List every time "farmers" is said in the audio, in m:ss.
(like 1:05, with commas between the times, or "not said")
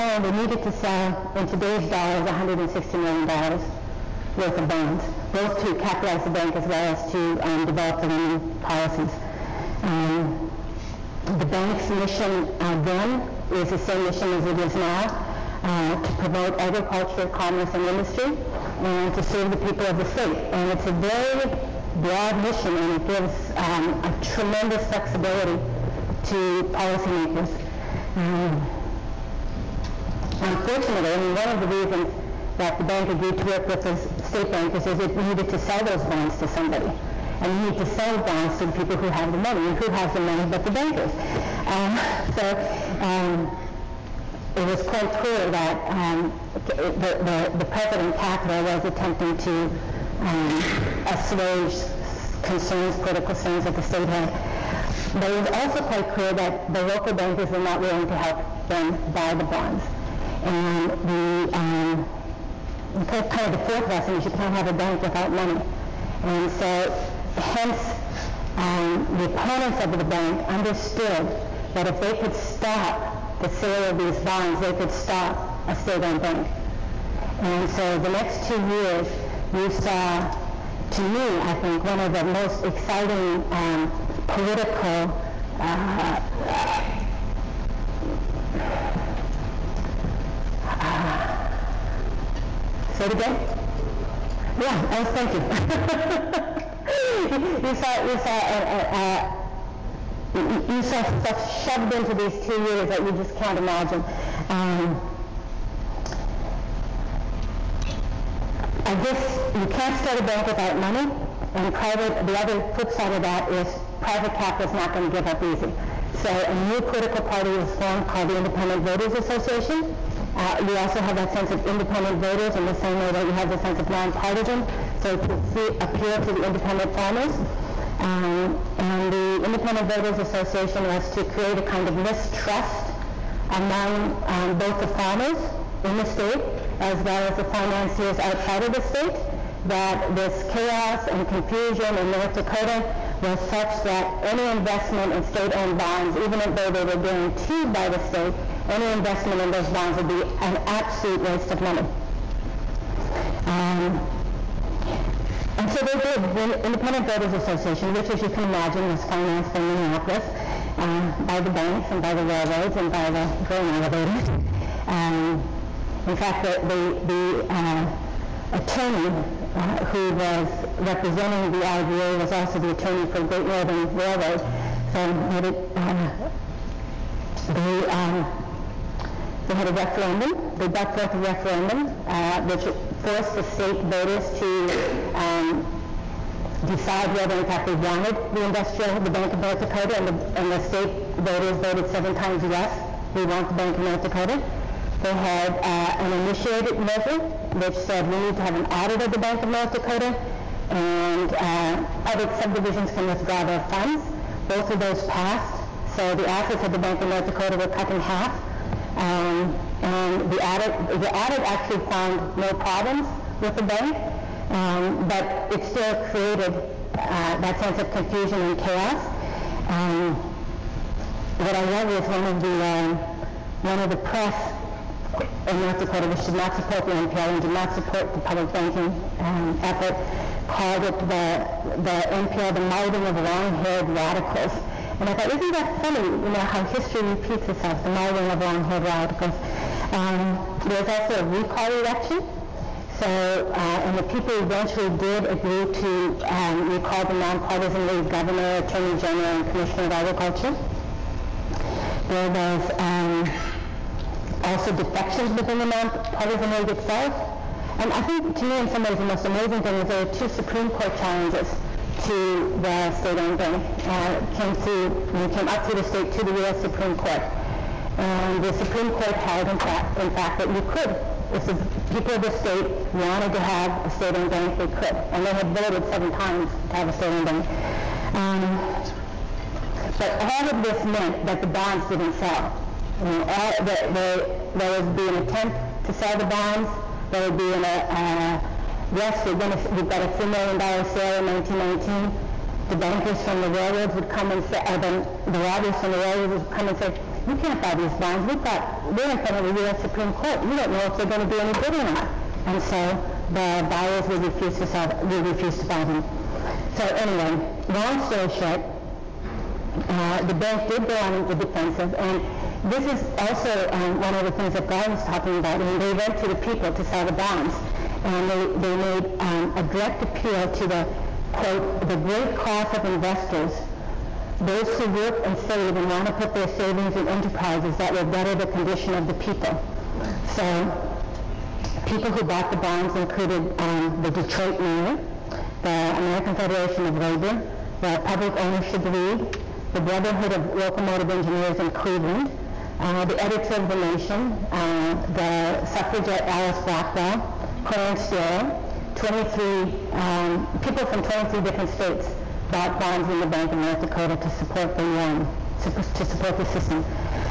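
2:06, 2:14.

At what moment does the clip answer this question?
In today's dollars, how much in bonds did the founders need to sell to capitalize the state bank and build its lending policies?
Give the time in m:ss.
0:02.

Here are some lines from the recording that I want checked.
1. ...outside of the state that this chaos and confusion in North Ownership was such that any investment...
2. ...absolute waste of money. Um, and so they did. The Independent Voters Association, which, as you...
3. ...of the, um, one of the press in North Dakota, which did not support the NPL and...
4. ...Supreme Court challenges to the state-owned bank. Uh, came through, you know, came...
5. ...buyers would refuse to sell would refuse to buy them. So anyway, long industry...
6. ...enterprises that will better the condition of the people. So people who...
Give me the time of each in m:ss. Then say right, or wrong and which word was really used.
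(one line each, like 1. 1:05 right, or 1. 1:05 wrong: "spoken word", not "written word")
1. 2:18 wrong: "Dakota", not "Ownership"
2. 2:30 right
3. 3:42 right
4. 4:20 right
5. 5:03 wrong: "story", not "industry"
6. 5:27 right.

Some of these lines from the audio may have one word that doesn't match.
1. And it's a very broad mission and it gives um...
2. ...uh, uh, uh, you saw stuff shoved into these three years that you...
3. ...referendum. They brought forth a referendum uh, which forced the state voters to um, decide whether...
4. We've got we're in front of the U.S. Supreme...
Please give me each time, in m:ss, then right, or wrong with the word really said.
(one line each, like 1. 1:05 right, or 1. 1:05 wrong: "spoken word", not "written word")
1. 0:20 right
2. 1:38 wrong: "two", not "three"
3. 2:59 right
4. 4:58 right.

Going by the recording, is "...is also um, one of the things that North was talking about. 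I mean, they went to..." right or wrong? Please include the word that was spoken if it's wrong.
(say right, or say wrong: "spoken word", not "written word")
wrong: "Gar", not "North".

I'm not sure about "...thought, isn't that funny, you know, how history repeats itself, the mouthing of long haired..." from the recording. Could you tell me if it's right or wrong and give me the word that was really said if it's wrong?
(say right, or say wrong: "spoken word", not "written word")
right.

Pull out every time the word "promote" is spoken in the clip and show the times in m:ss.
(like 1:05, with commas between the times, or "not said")
0:16.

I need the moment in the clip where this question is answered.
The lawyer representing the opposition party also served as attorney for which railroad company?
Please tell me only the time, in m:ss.
2:53.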